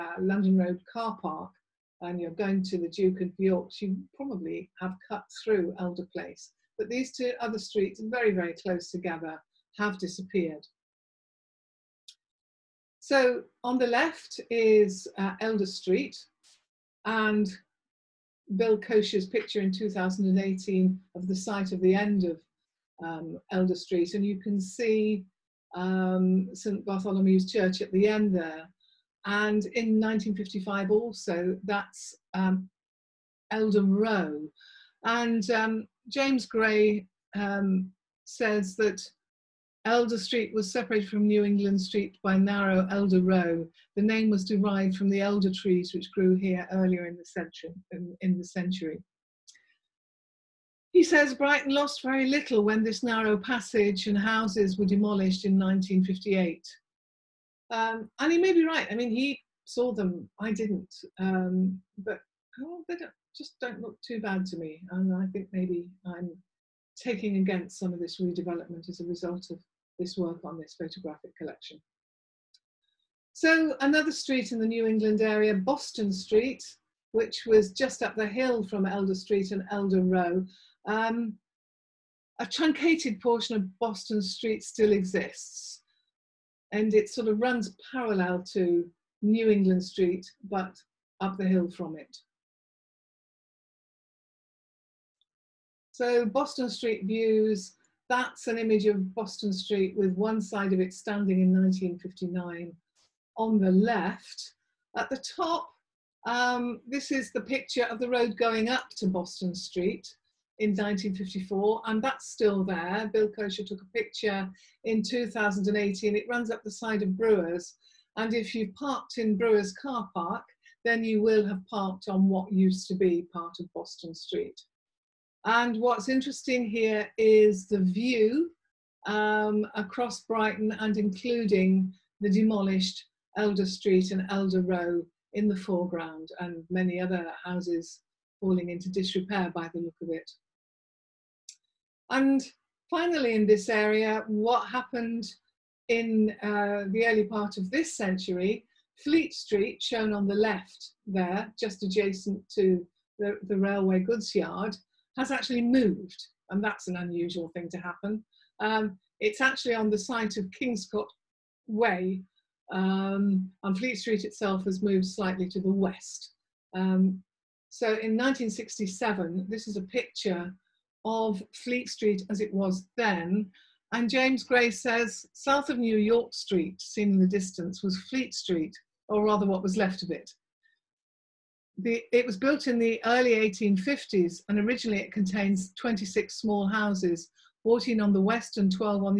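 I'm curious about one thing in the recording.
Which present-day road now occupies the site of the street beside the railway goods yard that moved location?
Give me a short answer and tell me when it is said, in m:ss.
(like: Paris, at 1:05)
Kingscott Way, at 2:40.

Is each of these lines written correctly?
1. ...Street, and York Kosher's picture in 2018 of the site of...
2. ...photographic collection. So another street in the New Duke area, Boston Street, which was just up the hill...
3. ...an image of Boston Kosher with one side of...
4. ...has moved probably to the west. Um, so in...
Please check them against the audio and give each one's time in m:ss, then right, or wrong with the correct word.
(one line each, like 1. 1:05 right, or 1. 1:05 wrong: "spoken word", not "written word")
1. 0:15 wrong: "Bill", not "York"
2. 1:10 wrong: "England", not "Duke"
3. 1:38 wrong: "Street", not "Kosher"
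4. 2:44 wrong: "slightly", not "probably".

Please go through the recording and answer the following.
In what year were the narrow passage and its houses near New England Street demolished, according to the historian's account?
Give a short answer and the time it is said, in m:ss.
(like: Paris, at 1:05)
1958, at 0:55.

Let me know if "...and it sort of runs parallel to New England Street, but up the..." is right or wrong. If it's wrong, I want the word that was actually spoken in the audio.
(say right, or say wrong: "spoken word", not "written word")
right.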